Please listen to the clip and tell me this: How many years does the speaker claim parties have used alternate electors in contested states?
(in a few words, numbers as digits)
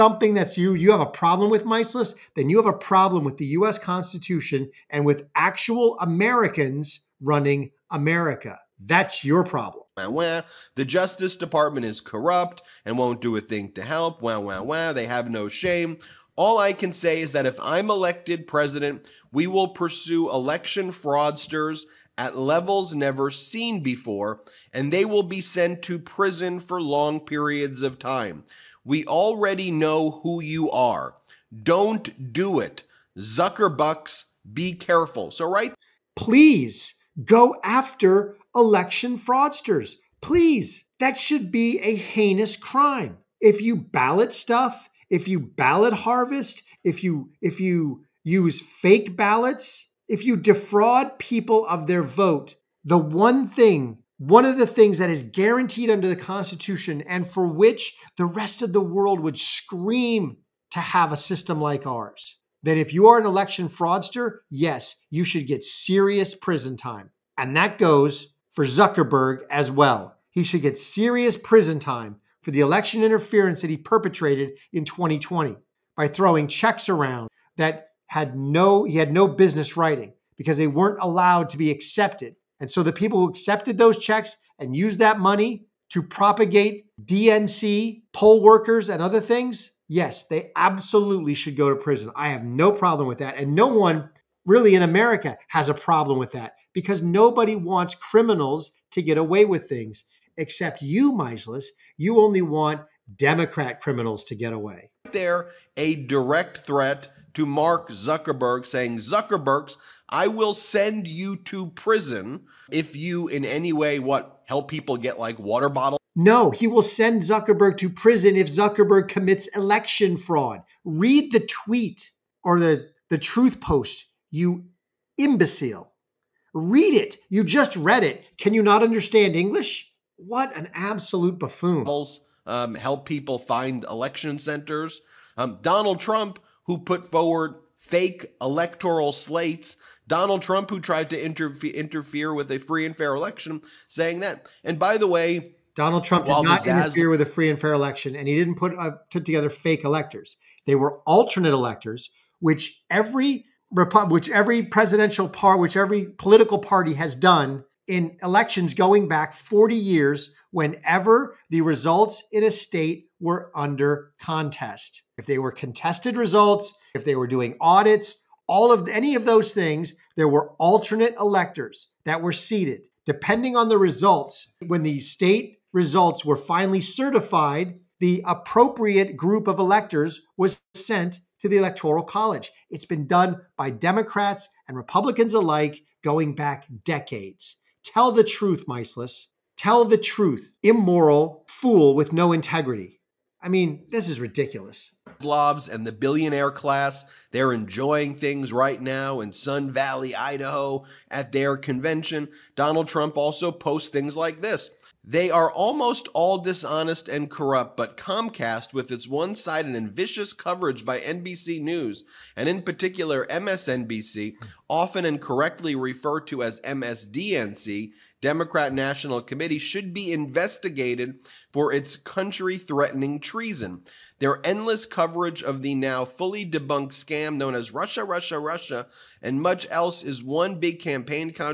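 40 years.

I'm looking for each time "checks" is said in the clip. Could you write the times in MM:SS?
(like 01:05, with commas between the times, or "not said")
01:16, 01:23.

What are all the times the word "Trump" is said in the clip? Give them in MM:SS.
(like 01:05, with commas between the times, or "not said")
02:16, 02:20, 02:26, 03:22.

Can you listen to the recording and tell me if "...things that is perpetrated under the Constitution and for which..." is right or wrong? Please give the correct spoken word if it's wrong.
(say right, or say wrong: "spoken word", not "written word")
wrong: "guaranteed", not "perpetrated".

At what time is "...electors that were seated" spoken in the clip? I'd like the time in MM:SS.
02:51.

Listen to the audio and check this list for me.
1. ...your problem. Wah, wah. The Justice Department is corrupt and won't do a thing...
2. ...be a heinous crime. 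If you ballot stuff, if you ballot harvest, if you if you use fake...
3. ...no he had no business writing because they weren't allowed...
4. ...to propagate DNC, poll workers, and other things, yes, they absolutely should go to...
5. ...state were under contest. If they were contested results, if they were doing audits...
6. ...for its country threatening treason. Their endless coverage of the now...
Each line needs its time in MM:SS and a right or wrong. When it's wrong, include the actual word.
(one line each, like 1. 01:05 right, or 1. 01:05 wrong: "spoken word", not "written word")
1. 00:09 right
2. 00:41 right
3. 01:18 right
4. 01:25 right
5. 02:42 right
6. 03:41 right.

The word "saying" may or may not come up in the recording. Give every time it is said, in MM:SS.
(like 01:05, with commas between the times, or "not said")
01:48, 02:23.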